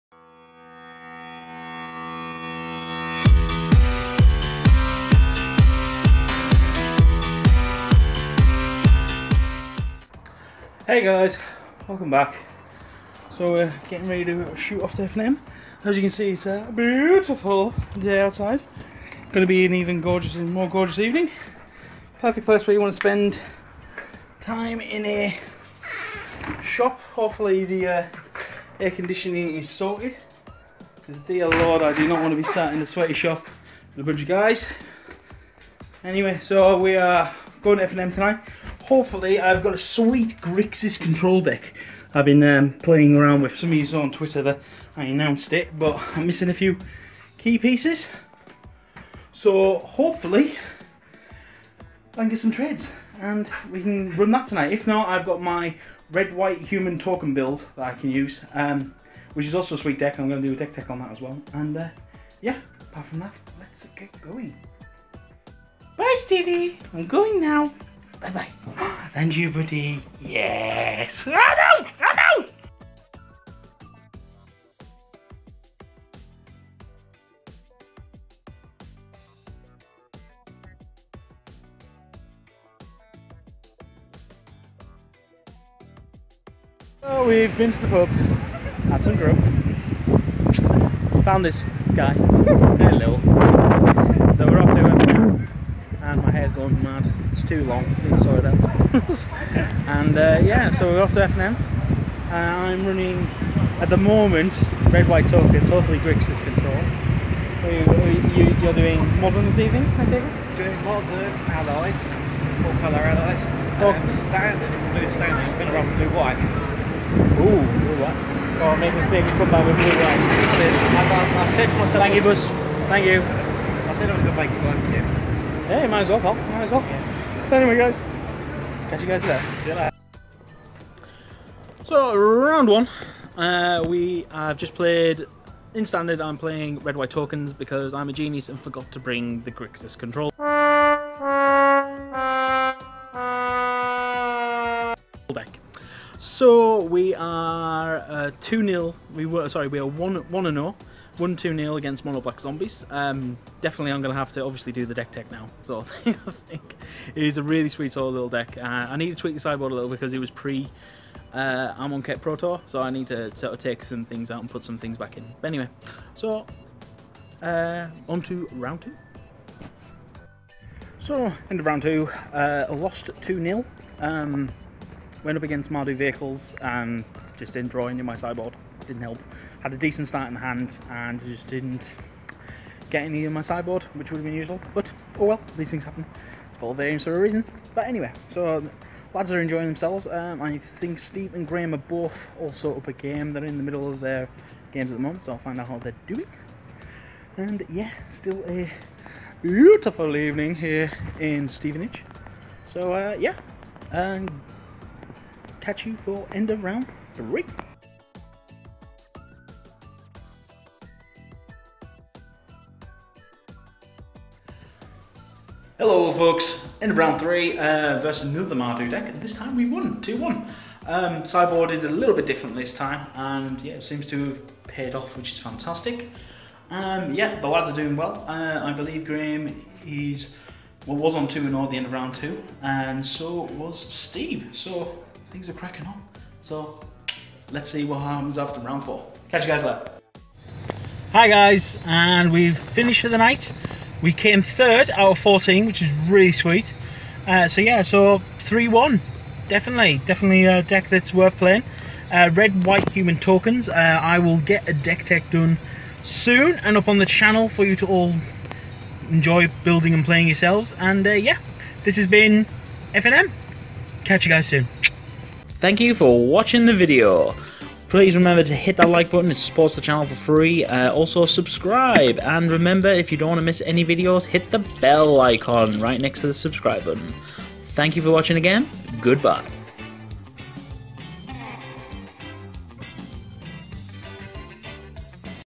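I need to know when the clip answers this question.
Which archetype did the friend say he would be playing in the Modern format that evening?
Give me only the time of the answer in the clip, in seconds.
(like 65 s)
112 s.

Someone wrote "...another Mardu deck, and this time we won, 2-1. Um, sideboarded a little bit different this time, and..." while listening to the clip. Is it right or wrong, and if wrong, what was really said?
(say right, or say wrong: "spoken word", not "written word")
right.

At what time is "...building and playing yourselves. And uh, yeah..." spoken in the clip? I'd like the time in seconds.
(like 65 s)
259 s.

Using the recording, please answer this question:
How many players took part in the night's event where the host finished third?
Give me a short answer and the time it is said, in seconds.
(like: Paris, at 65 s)
14, at 245 s.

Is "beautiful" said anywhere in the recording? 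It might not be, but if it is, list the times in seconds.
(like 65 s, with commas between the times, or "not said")
16 s, 199 s.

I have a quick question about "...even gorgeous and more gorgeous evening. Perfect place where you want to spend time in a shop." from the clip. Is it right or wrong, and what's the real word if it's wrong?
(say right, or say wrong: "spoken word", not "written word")
right.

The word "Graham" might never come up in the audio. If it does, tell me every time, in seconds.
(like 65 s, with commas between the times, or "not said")
191 s, 229 s.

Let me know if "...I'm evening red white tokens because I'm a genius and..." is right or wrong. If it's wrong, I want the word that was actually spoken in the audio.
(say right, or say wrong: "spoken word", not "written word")
wrong: "playing", not "evening".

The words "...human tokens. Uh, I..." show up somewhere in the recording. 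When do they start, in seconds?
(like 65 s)
252 s.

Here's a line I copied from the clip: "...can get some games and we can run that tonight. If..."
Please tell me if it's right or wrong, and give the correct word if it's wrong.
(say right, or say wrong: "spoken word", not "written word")
wrong: "trades", not "games".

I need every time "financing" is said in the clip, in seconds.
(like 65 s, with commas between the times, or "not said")
not said.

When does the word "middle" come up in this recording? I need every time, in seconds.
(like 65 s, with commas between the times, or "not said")
193 s.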